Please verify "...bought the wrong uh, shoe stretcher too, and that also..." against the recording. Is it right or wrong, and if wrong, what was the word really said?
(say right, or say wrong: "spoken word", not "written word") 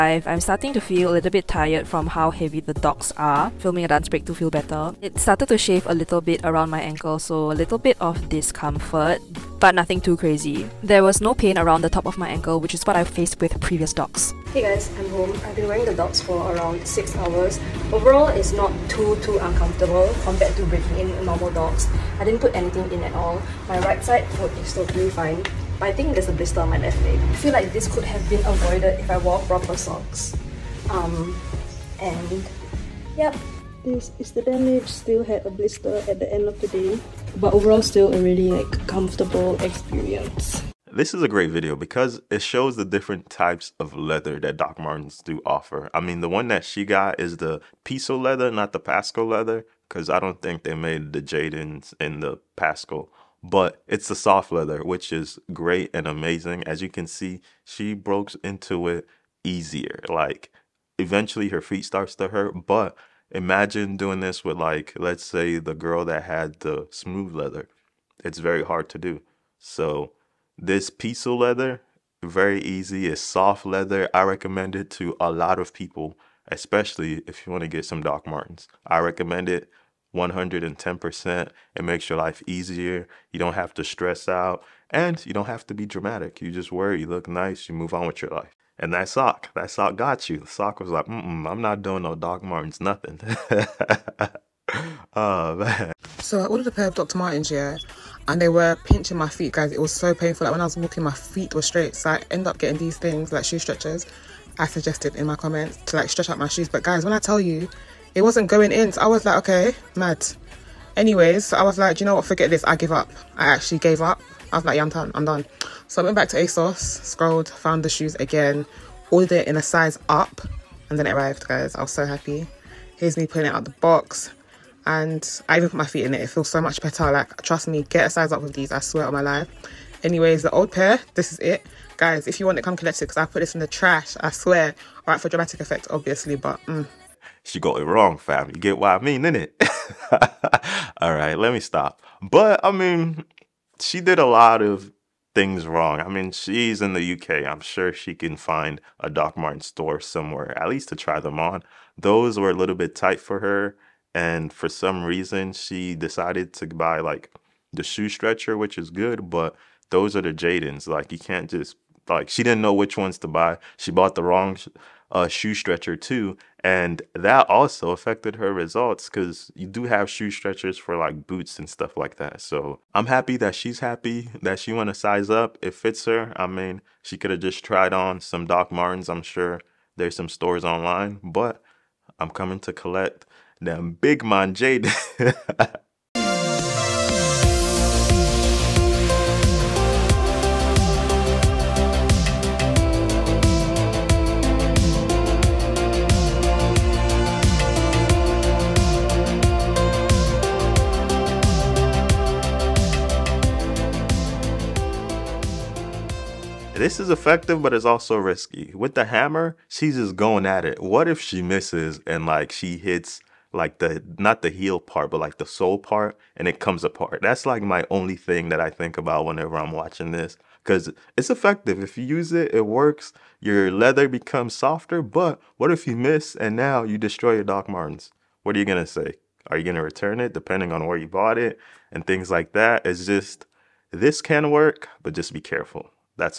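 right.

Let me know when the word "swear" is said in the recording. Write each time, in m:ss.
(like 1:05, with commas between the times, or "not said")
2:08, 2:14.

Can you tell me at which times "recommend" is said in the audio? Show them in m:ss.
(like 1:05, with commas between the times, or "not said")
1:14, 1:18.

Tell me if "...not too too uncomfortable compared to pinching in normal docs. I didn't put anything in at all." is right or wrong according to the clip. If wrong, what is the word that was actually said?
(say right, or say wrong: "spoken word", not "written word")
wrong: "breaking", not "pinching".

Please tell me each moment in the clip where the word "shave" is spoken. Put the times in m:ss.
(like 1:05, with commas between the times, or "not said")
0:05.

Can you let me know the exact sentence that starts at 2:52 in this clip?
So I'm happy that she's happy that she want to size up.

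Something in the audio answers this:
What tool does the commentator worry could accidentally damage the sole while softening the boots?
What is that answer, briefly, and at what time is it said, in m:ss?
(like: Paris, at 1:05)
hammer, at 3:29.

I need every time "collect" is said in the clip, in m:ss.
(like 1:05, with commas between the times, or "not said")
2:12, 3:02.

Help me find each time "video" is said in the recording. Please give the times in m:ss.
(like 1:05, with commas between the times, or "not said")
0:41.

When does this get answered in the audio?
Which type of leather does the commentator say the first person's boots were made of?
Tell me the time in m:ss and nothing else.
0:47.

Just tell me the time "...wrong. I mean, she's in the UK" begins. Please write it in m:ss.
2:25.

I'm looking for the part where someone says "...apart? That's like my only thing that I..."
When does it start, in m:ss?
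3:36.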